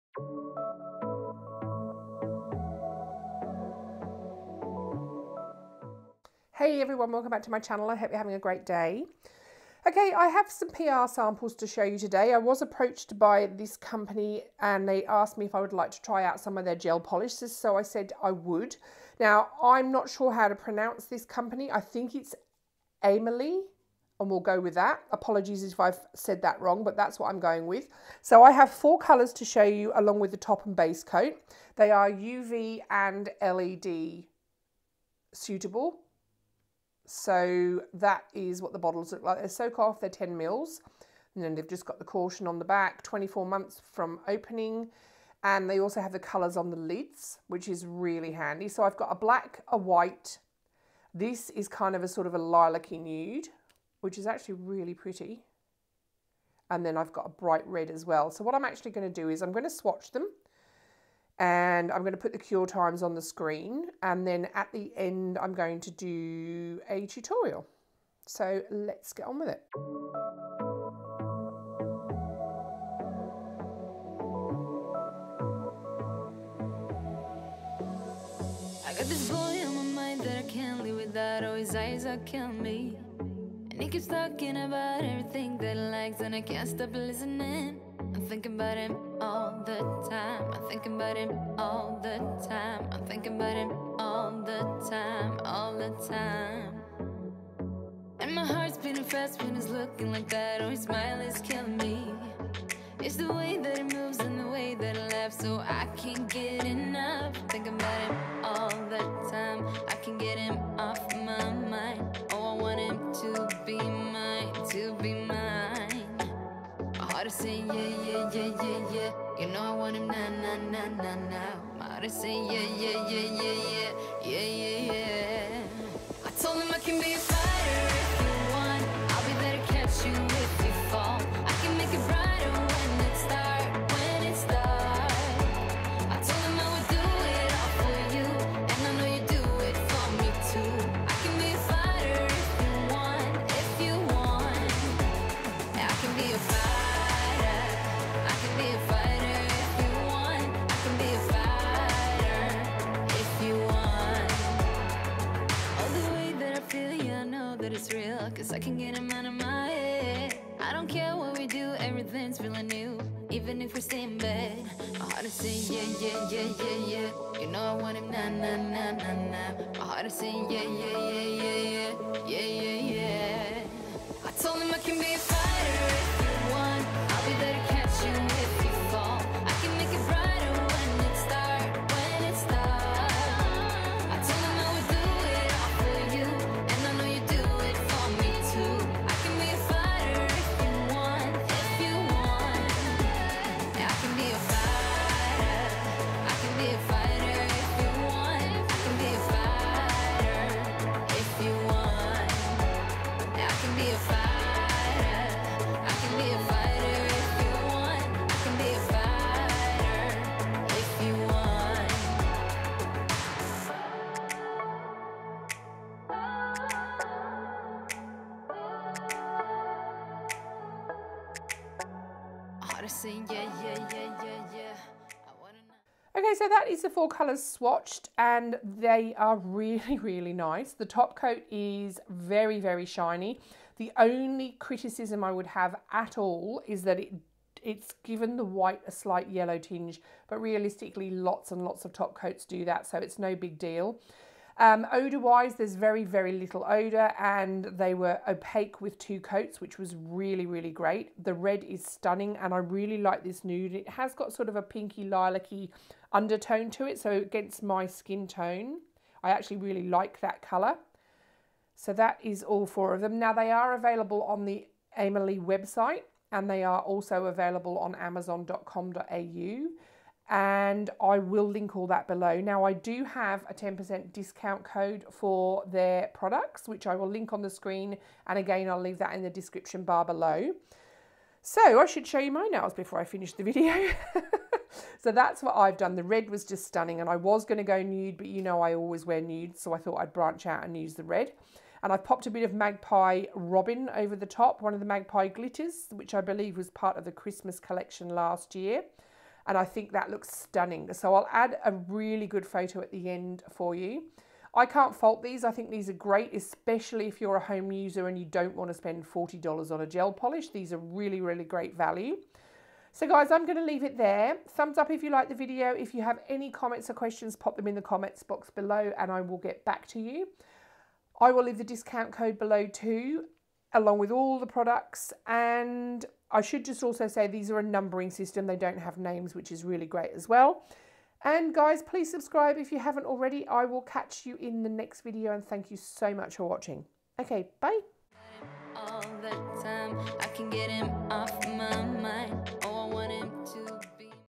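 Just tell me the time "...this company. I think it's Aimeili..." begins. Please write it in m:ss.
0:21.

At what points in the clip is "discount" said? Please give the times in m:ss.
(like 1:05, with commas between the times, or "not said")
4:34, 5:21.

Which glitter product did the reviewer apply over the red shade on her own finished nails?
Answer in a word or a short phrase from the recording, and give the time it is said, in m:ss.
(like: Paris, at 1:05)
Magpie Robin, at 4:52.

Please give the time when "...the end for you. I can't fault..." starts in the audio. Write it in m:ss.
5:02.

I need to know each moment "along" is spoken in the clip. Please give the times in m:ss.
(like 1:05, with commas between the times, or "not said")
0:29, 5:23.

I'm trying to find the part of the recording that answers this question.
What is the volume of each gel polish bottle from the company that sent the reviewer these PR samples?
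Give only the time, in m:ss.
0:40.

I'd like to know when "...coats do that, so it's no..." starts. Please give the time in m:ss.
4:02.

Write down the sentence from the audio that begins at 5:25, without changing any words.
And I should just also say these are a numbering system.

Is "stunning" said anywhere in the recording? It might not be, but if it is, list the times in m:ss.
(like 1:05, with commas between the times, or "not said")
4:11, 4:46, 5:00.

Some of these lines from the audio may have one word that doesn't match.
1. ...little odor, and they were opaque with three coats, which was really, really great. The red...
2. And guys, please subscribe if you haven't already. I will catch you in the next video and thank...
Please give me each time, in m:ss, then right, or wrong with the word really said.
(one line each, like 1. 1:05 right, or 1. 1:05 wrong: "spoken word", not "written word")
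1. 4:06 wrong: "two", not "three"
2. 5:31 right.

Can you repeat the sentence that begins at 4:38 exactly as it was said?
And again, I'll leave that in the description bar below.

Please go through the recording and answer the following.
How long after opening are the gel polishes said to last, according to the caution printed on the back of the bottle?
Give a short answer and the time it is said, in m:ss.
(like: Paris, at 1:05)
24 months, at 0:43.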